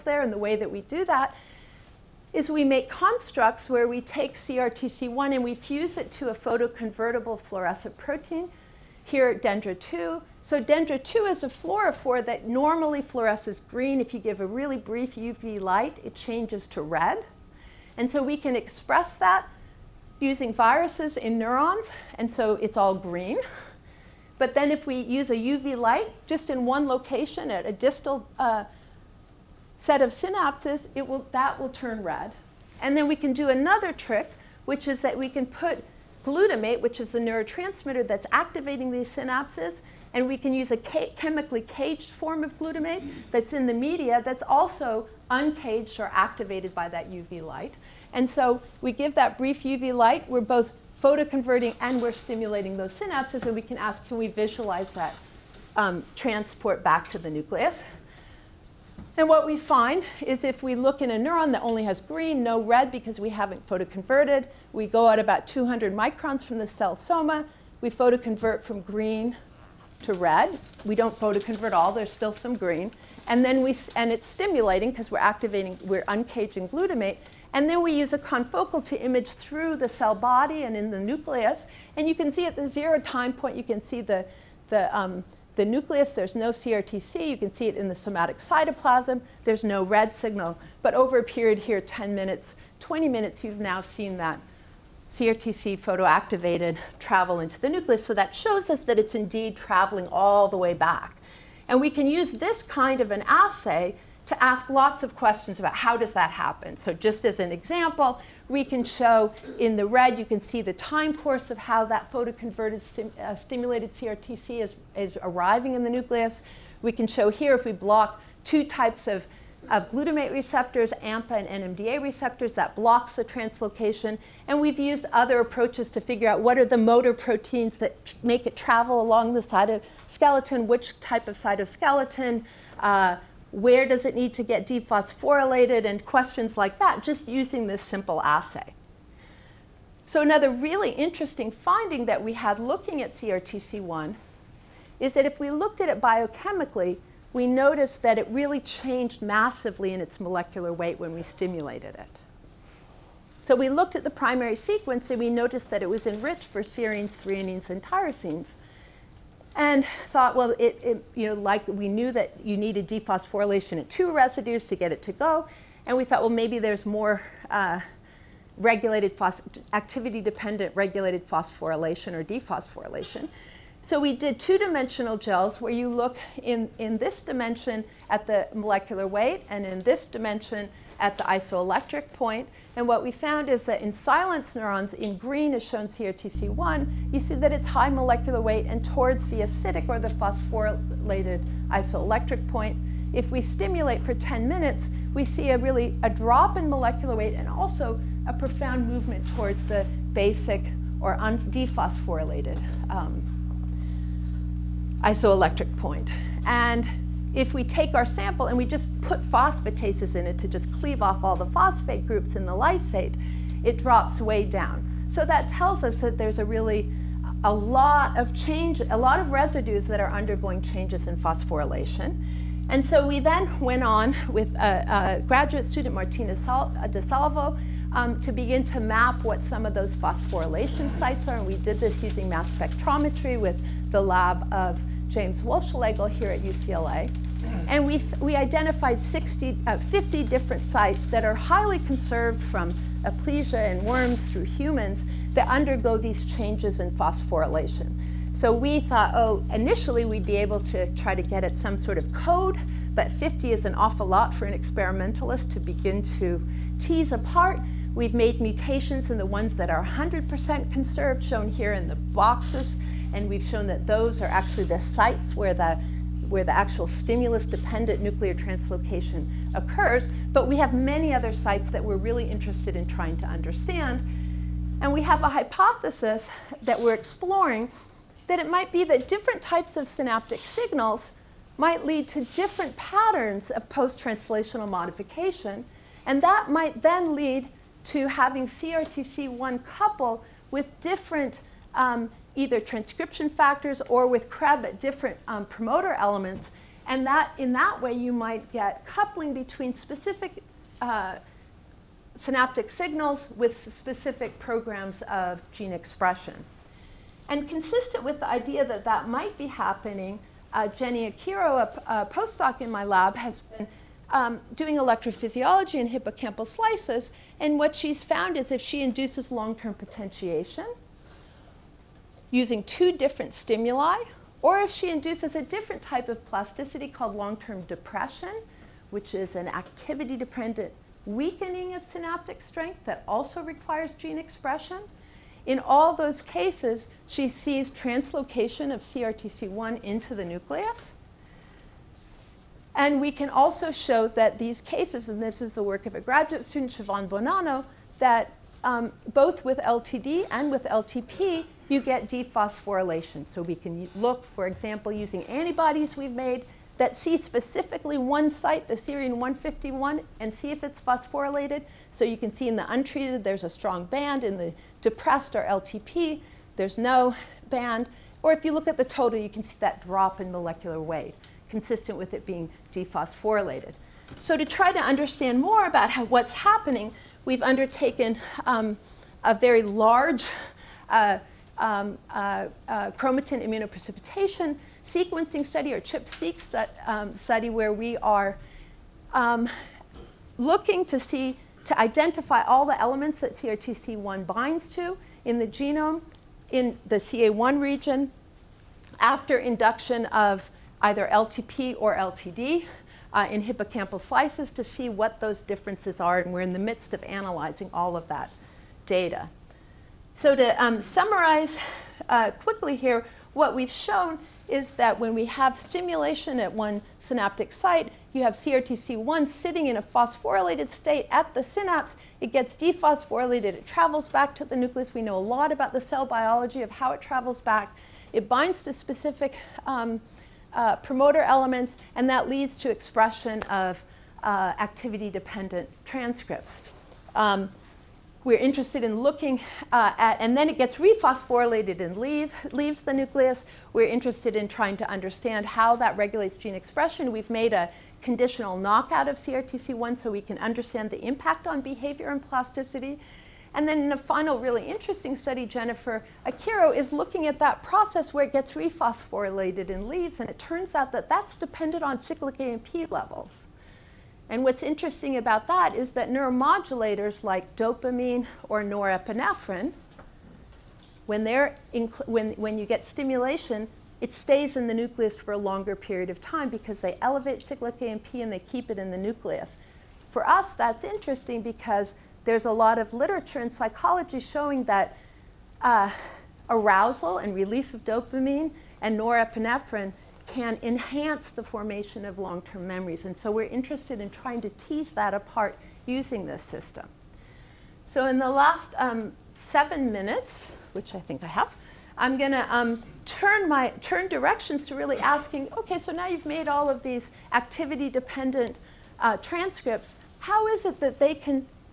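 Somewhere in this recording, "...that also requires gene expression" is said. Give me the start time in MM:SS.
05:32.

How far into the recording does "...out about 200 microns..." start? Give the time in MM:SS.
01:05.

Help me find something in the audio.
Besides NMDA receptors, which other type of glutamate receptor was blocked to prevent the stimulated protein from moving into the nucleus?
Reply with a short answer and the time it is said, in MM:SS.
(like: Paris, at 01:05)
AMPA, at 02:01.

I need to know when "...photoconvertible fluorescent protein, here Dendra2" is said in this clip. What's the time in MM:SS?
00:06.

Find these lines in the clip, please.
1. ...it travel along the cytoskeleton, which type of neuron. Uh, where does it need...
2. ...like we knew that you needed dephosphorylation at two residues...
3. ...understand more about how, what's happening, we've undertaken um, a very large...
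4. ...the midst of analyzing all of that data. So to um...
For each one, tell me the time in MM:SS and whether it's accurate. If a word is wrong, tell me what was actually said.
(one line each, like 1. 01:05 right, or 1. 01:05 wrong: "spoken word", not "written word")
1. 02:08 wrong: "cytoskeleton", not "neuron"
2. 02:41 right
3. 06:14 right
4. 06:46 right.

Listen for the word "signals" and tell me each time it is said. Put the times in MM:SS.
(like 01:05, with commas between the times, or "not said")
01:30, 04:40, 05:02.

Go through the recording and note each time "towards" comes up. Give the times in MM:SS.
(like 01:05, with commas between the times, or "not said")
03:08, 03:19.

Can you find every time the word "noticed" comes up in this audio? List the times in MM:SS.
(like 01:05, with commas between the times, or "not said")
02:27, 02:35.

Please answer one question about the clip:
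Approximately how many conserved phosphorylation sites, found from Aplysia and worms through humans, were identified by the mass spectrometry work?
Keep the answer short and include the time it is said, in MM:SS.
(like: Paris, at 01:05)
50, at 03:59.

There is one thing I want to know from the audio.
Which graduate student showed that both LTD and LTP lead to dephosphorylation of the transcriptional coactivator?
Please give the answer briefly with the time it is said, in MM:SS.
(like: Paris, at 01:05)
Siobhan Bonanno, at 05:46.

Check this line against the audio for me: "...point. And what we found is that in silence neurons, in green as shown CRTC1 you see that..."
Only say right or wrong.
right.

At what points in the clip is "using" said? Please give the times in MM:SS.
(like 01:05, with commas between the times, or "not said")
00:20, 02:17, 03:52, 05:22, 05:54, 08:15.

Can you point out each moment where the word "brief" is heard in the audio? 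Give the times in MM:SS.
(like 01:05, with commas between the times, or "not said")
00:14, 00:49.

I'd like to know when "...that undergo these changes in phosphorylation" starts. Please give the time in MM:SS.
04:05.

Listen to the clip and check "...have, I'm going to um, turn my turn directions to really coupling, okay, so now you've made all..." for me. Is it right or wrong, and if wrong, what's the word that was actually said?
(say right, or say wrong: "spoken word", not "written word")
wrong: "asking", not "coupling".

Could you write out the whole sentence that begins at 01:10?
We don't photoconvert all, there's still some green.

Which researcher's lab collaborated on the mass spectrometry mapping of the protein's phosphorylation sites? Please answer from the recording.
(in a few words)
James Wohlschlegel.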